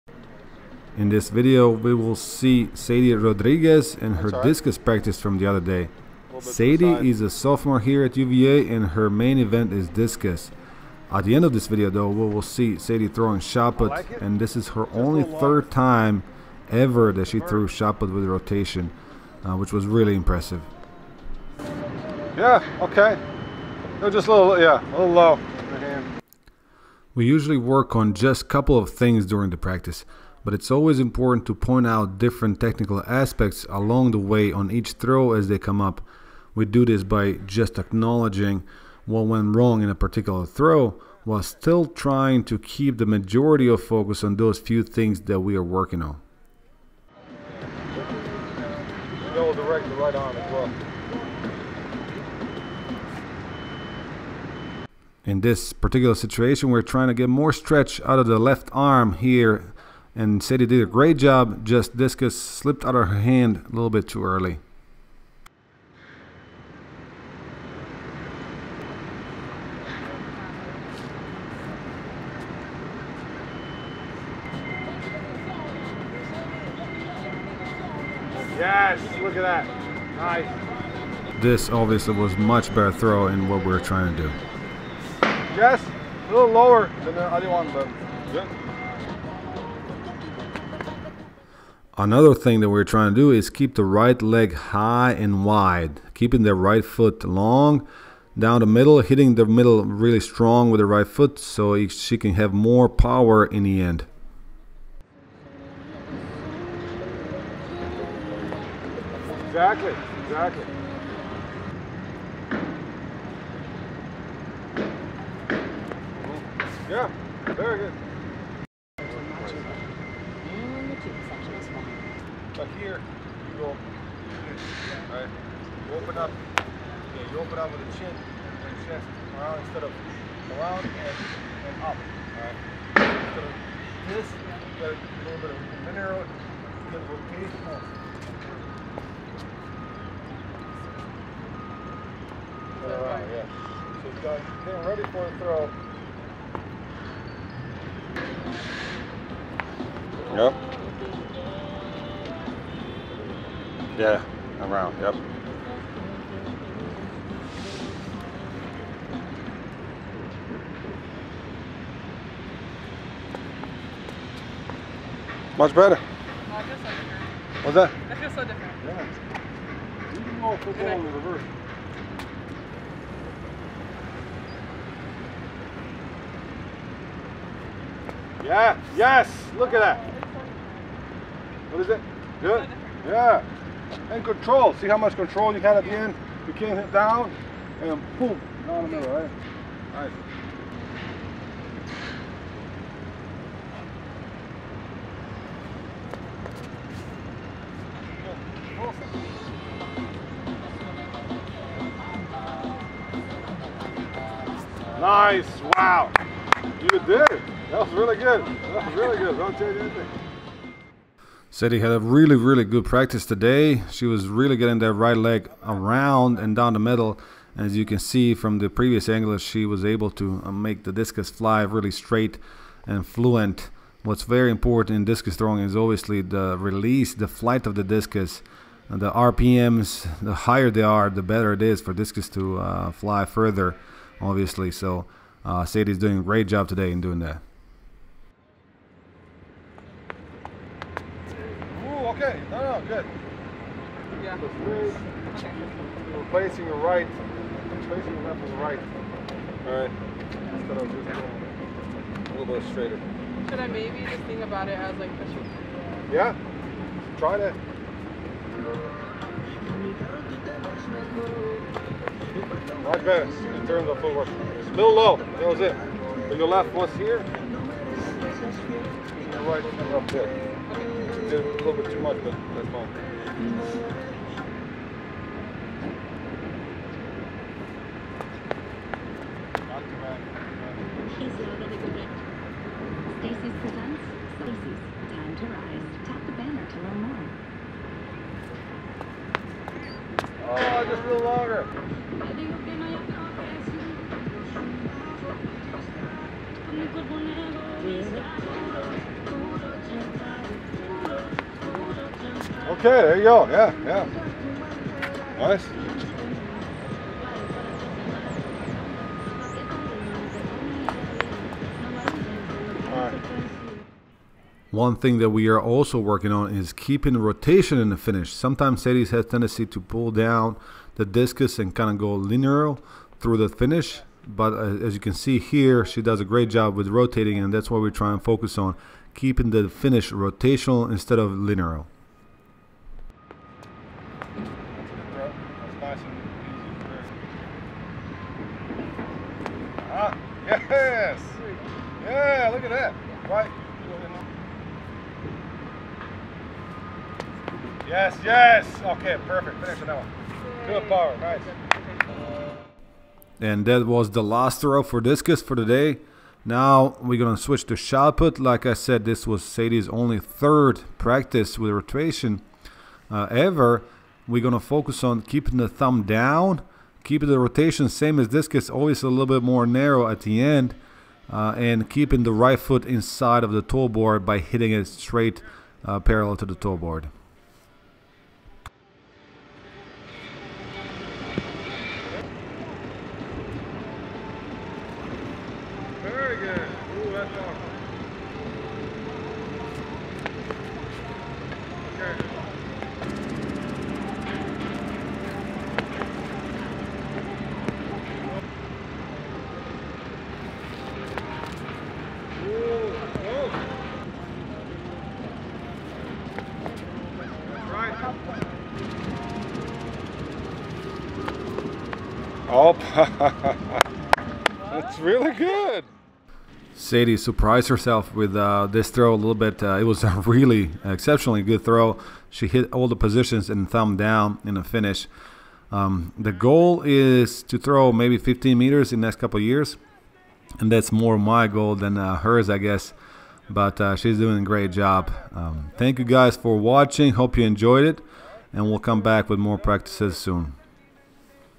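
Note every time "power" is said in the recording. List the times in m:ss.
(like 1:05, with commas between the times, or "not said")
1:42, 5:50.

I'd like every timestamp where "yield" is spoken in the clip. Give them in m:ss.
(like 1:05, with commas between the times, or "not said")
not said.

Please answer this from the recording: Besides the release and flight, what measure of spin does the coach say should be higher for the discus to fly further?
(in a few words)
RPMs.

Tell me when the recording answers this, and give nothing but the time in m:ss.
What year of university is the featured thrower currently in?
0:07.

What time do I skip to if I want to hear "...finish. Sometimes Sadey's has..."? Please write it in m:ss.
5:17.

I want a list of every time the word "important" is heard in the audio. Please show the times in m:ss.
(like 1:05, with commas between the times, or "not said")
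0:30, 3:44.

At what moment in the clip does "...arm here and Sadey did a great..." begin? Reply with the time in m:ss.
0:58.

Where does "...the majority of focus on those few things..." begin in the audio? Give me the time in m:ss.
0:42.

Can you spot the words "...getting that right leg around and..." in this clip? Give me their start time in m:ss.
3:34.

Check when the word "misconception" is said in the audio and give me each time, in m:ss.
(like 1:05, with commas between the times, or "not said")
not said.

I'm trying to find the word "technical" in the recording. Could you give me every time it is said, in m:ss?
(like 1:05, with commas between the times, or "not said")
0:32.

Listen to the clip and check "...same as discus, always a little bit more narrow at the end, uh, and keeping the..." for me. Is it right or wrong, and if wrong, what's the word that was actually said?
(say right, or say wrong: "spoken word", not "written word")
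right.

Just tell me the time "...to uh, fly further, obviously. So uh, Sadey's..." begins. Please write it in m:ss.
3:52.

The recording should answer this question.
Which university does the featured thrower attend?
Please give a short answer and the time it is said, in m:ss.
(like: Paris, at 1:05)
UVA, at 0:08.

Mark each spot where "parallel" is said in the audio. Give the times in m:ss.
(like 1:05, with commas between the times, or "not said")
6:15.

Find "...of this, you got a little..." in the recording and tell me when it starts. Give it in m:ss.
2:13.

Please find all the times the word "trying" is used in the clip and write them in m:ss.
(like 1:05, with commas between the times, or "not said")
0:41, 0:56, 1:23, 1:32.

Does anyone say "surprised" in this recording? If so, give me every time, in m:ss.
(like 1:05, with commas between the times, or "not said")
6:57.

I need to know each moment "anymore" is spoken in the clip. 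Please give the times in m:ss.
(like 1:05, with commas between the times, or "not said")
not said.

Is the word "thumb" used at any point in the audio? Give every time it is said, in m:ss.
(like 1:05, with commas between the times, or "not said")
6:05, 7:03.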